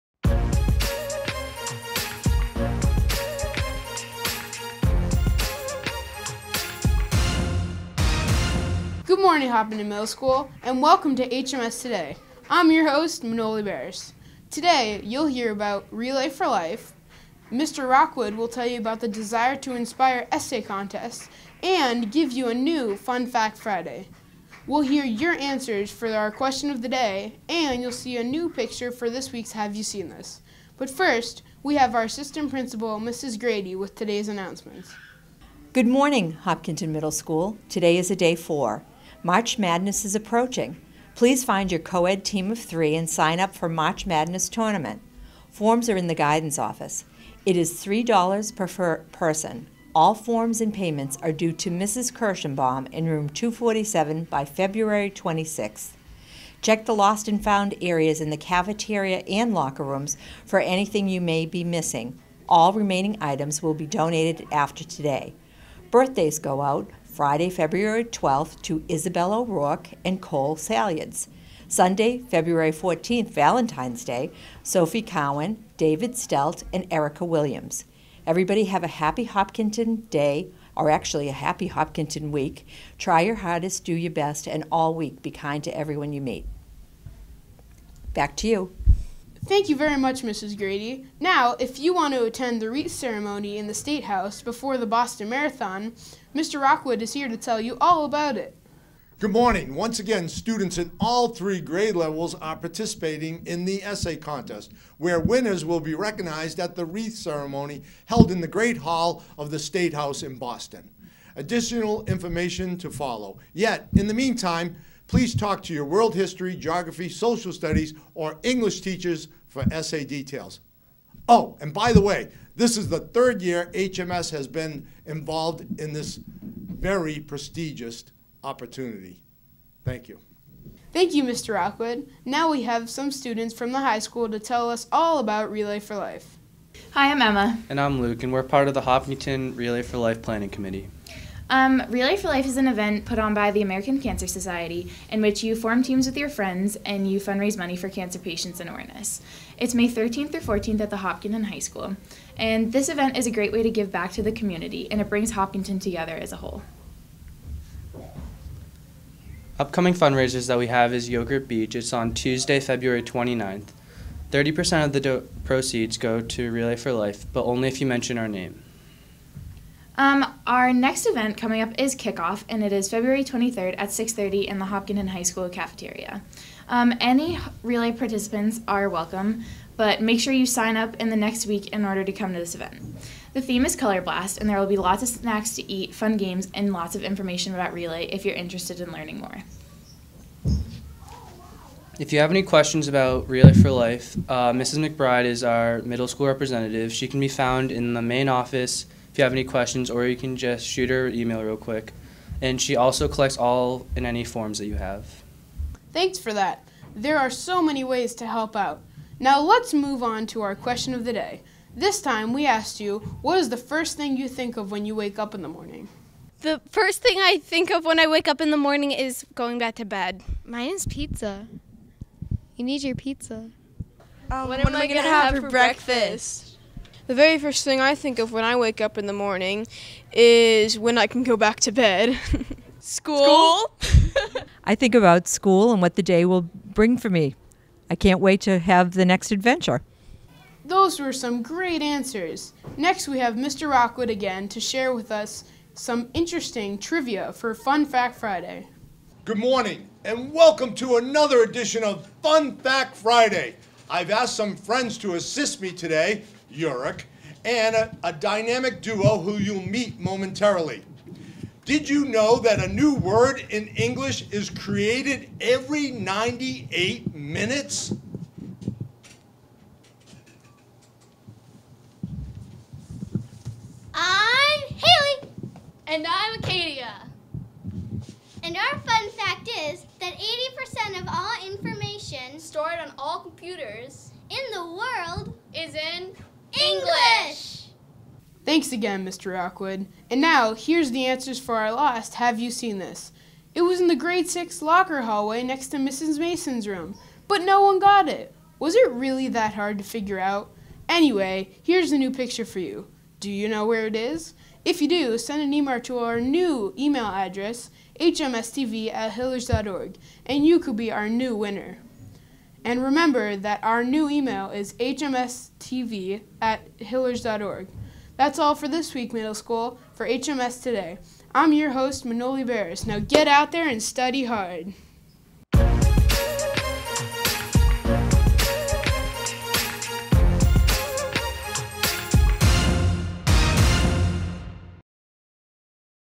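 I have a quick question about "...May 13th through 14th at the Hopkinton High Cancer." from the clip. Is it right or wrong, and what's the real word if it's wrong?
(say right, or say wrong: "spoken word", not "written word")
wrong: "School", not "Cancer".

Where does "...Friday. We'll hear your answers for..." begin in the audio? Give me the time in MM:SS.
00:23.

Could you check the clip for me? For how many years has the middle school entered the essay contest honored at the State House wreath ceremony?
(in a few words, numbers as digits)
third year.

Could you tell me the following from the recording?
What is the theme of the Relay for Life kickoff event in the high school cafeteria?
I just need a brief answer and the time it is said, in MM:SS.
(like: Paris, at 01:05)
Color Blast, at 03:03.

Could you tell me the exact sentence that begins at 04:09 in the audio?
Good morning, and welcome to another edition of Fun Fact Friday.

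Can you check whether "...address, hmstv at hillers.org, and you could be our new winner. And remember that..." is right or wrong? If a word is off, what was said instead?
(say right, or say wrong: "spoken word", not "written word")
right.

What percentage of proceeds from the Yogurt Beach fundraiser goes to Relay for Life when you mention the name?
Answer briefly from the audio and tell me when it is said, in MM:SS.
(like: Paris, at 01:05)
30%, at 02:44.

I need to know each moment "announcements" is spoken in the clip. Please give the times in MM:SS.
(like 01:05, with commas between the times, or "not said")
00:34.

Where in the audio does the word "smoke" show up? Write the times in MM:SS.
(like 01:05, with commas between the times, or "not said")
not said.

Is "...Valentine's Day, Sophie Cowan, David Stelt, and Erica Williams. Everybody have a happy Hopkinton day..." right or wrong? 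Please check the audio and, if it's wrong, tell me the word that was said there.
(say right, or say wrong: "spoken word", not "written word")
right.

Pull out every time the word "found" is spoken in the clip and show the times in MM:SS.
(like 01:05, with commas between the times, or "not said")
00:57, 03:17.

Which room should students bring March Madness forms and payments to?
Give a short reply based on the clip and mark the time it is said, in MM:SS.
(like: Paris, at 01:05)
Room 247, at 00:53.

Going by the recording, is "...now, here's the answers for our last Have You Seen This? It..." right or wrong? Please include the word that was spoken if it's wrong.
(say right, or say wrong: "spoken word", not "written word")
right.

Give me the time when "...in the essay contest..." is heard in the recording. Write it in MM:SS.
01:43.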